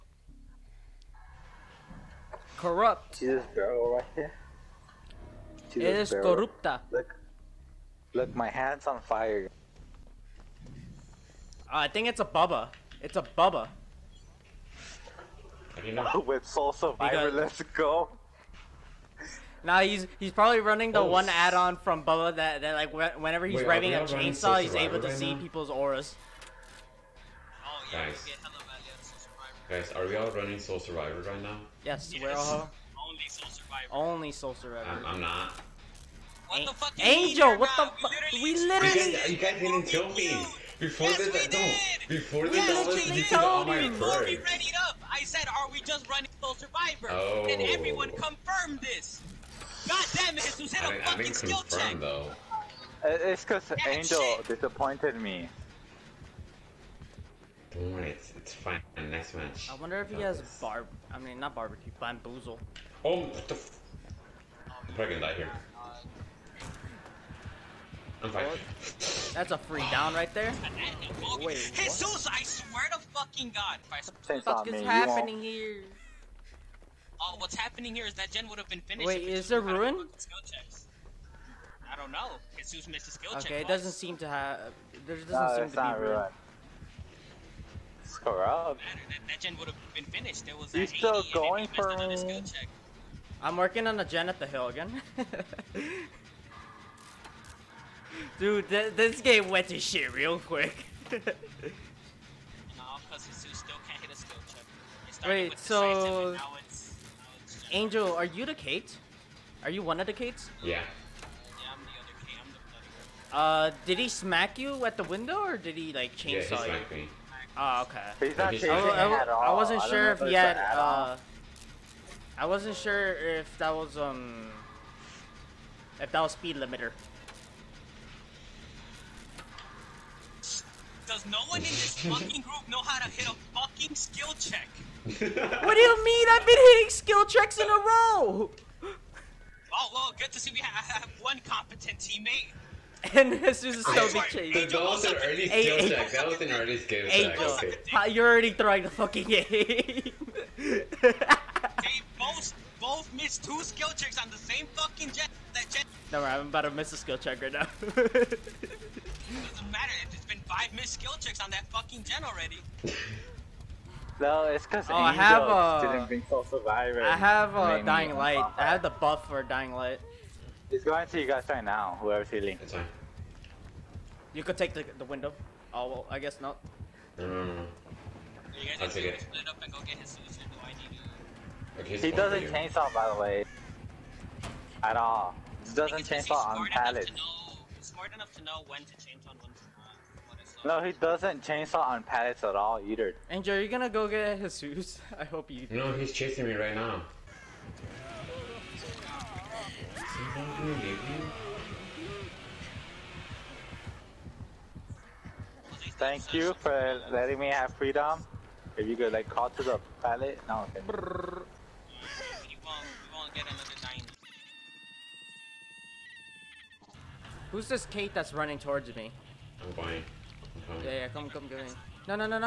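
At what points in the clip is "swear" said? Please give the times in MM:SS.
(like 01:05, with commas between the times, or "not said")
01:12.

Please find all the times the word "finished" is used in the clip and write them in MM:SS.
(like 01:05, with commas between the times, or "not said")
01:18, 01:30.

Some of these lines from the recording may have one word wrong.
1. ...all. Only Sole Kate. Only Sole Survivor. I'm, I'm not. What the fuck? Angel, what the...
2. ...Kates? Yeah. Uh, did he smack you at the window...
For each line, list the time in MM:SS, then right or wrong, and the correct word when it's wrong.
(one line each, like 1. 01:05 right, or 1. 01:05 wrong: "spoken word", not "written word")
1. 00:32 wrong: "Survivor", not "Kate"
2. 01:50 right.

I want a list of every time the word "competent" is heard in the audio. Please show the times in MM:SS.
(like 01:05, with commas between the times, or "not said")
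02:21.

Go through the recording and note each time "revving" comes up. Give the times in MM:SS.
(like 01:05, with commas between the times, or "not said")
00:23.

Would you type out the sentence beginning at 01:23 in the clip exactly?
Okay, it doesn't seem to have.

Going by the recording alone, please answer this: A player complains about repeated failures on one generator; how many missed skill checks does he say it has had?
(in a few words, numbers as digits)
5.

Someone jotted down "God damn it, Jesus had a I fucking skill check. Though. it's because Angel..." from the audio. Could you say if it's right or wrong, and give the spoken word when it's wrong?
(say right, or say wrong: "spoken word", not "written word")
right.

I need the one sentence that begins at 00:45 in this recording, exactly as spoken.
I said, are we just running Sole Survivor?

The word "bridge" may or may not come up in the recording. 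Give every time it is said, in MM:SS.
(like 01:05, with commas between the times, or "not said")
not said.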